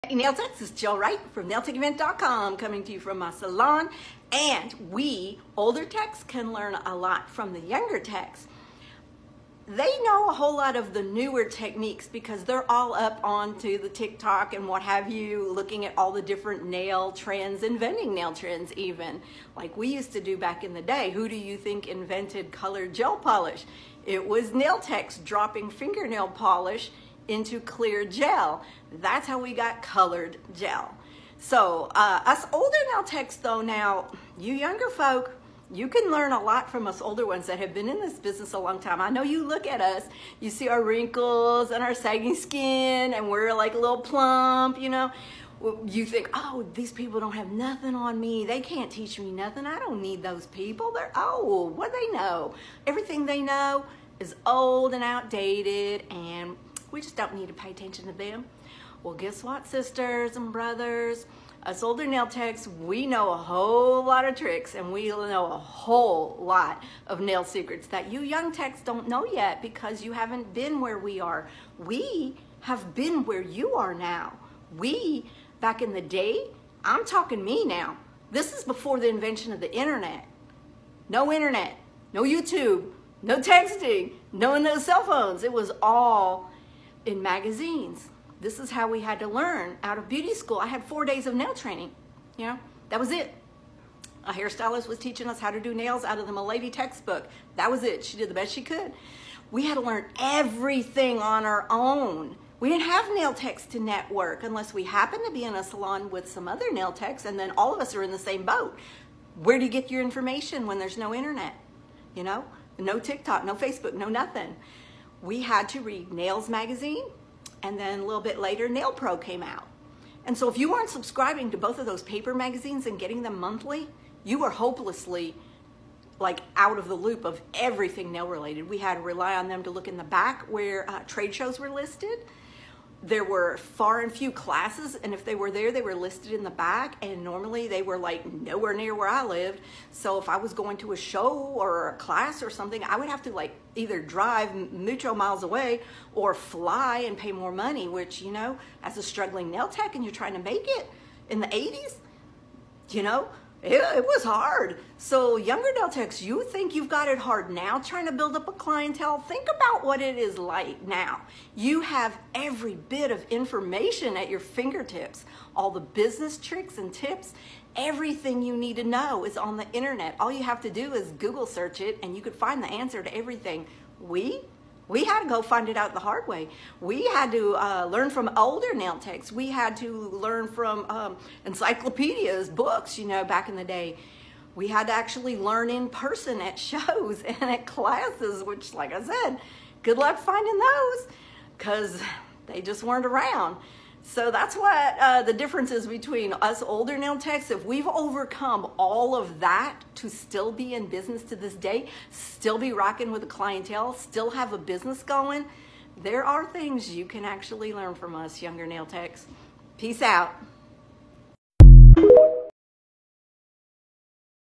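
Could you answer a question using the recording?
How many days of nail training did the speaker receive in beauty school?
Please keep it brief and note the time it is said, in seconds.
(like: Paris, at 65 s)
4 days, at 90 s.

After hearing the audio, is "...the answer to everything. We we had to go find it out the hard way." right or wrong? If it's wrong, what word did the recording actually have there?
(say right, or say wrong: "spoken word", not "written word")
right.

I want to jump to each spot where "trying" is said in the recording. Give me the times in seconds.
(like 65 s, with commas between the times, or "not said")
150 s, 157 s.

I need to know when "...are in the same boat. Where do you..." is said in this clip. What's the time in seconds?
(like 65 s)
107 s.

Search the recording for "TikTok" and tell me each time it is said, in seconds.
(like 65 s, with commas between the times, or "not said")
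13 s, 112 s.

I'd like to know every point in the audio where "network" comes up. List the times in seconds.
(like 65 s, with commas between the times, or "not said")
103 s.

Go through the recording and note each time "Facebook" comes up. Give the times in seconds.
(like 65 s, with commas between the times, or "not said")
113 s.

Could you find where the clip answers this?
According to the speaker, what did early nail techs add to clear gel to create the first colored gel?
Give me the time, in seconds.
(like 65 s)
25 s.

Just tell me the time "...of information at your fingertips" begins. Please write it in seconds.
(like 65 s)
163 s.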